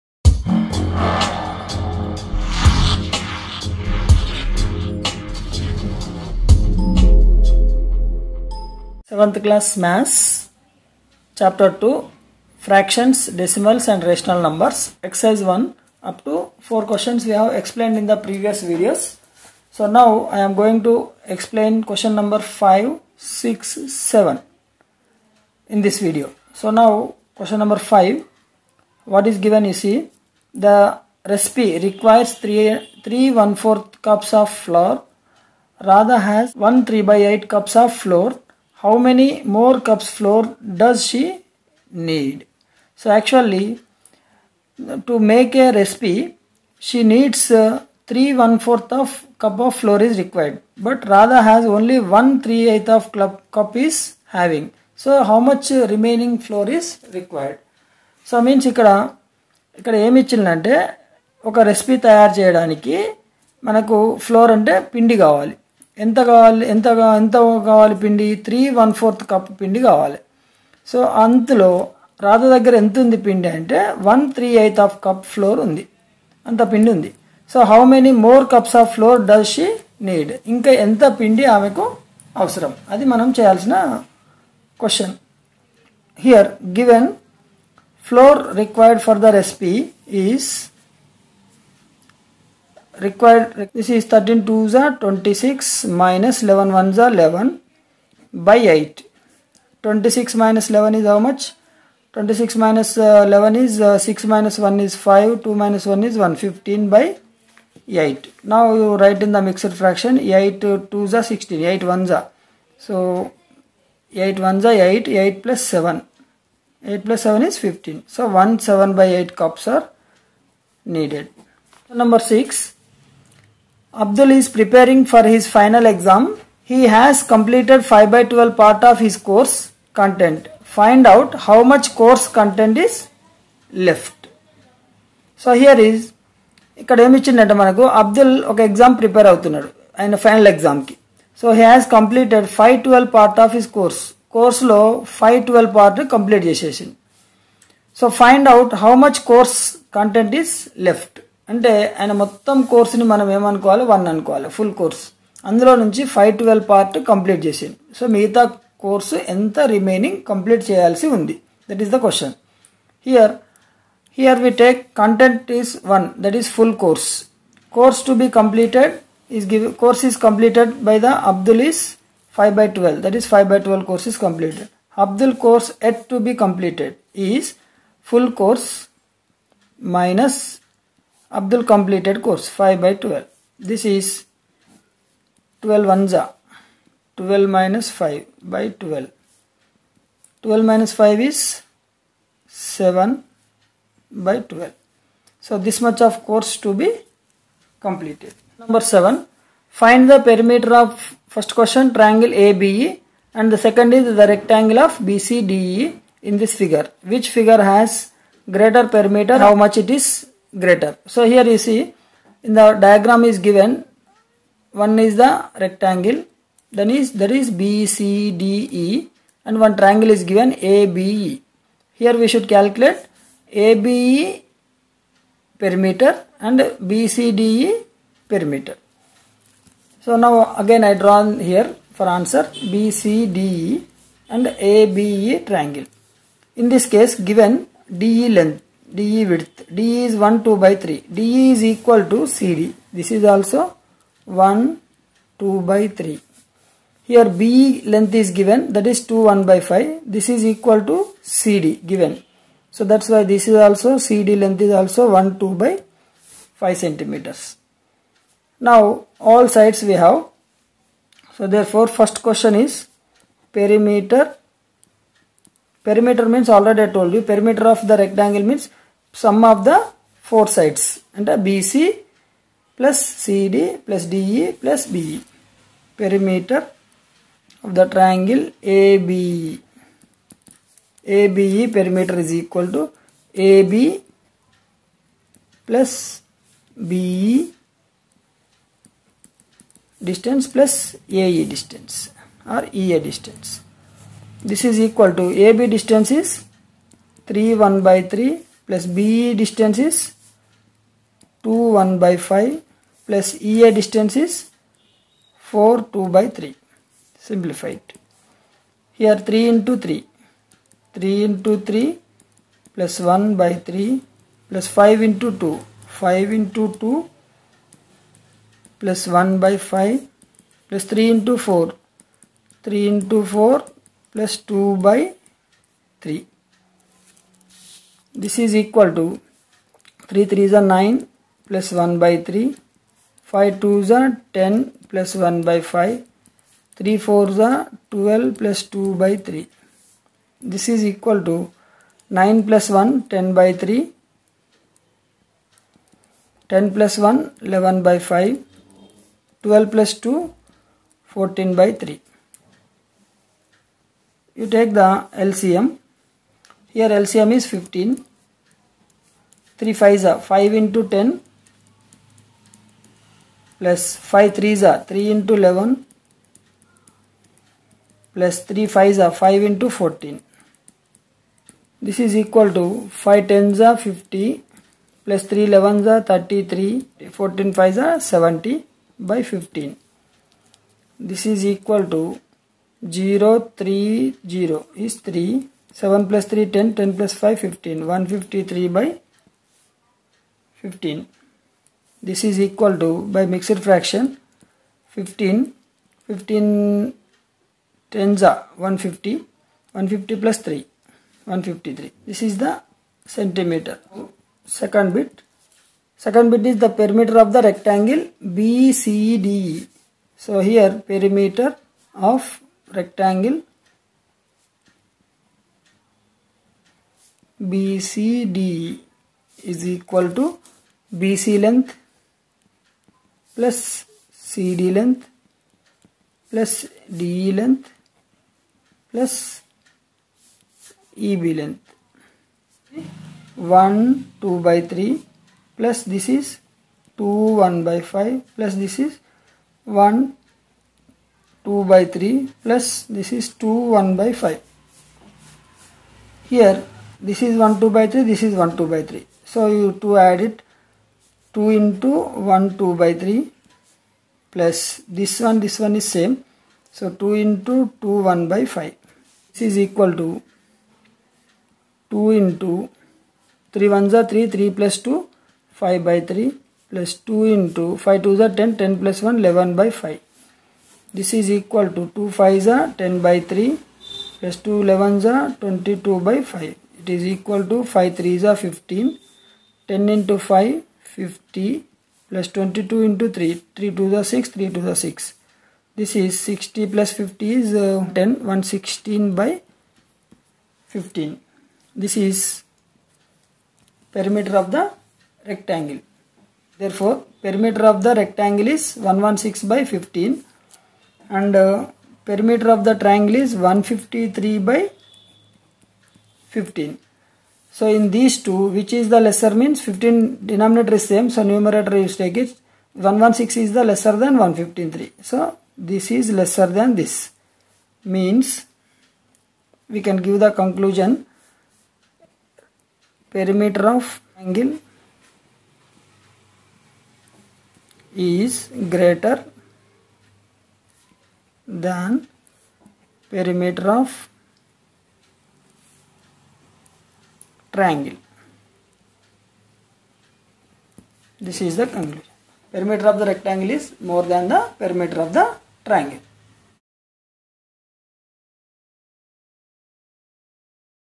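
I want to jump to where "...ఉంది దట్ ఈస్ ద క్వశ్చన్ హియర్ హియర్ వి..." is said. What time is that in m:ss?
2:41.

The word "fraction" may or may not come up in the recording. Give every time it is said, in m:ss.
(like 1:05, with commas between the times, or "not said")
0:12, 1:49, 6:33.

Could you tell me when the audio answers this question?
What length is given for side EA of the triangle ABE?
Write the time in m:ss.
5:05.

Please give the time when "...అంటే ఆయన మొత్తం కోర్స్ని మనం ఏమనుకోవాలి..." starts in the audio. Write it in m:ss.
2:31.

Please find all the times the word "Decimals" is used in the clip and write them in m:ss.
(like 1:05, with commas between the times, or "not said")
0:13.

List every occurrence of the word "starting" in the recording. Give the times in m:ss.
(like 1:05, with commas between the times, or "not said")
not said.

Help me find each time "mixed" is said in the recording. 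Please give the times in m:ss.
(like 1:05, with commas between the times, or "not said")
1:49, 6:33.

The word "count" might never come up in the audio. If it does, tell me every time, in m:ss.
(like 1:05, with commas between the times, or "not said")
not said.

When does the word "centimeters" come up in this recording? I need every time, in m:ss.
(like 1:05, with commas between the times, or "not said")
4:16, 6:43.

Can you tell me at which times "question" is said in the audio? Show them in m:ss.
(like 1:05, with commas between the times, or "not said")
0:16, 0:21, 0:27, 3:21, 4:22.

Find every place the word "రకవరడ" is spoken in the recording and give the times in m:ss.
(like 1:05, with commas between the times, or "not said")
0:50, 0:57, 1:28.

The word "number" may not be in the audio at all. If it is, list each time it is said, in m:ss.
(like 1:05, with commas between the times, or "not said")
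0:14, 0:22, 0:27, 2:02, 3:18.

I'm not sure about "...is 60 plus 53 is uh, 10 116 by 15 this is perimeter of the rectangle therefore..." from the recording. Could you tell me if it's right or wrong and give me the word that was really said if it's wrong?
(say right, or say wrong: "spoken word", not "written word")
wrong: "50", not "53".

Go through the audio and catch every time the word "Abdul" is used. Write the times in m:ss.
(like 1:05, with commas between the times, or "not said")
2:03, 3:01.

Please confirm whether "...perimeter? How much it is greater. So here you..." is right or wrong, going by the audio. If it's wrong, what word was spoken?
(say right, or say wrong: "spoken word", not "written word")
right.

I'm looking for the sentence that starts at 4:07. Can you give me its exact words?
Here BE length is given that is 2, 1 by 5.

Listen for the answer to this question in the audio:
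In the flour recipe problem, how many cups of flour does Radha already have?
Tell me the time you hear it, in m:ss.
0:36.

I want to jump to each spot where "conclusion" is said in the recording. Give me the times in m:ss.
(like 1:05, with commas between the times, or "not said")
8:40, 9:01.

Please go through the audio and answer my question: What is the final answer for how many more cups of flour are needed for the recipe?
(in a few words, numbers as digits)
1 7/8 cups.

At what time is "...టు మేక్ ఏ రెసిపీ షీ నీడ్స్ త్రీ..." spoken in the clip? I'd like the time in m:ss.
0:45.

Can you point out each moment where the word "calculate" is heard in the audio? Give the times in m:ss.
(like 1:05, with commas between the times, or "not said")
3:42.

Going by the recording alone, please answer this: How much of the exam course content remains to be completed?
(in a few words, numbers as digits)
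7/12.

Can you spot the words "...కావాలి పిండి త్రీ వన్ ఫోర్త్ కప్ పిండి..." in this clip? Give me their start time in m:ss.
1:07.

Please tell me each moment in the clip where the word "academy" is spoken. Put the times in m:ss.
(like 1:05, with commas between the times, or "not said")
not said.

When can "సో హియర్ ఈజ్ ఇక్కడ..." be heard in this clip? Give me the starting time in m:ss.
2:15.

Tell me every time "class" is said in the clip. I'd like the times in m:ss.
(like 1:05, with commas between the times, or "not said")
0:09.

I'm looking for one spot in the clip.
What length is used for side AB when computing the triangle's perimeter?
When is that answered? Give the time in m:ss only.
4:57.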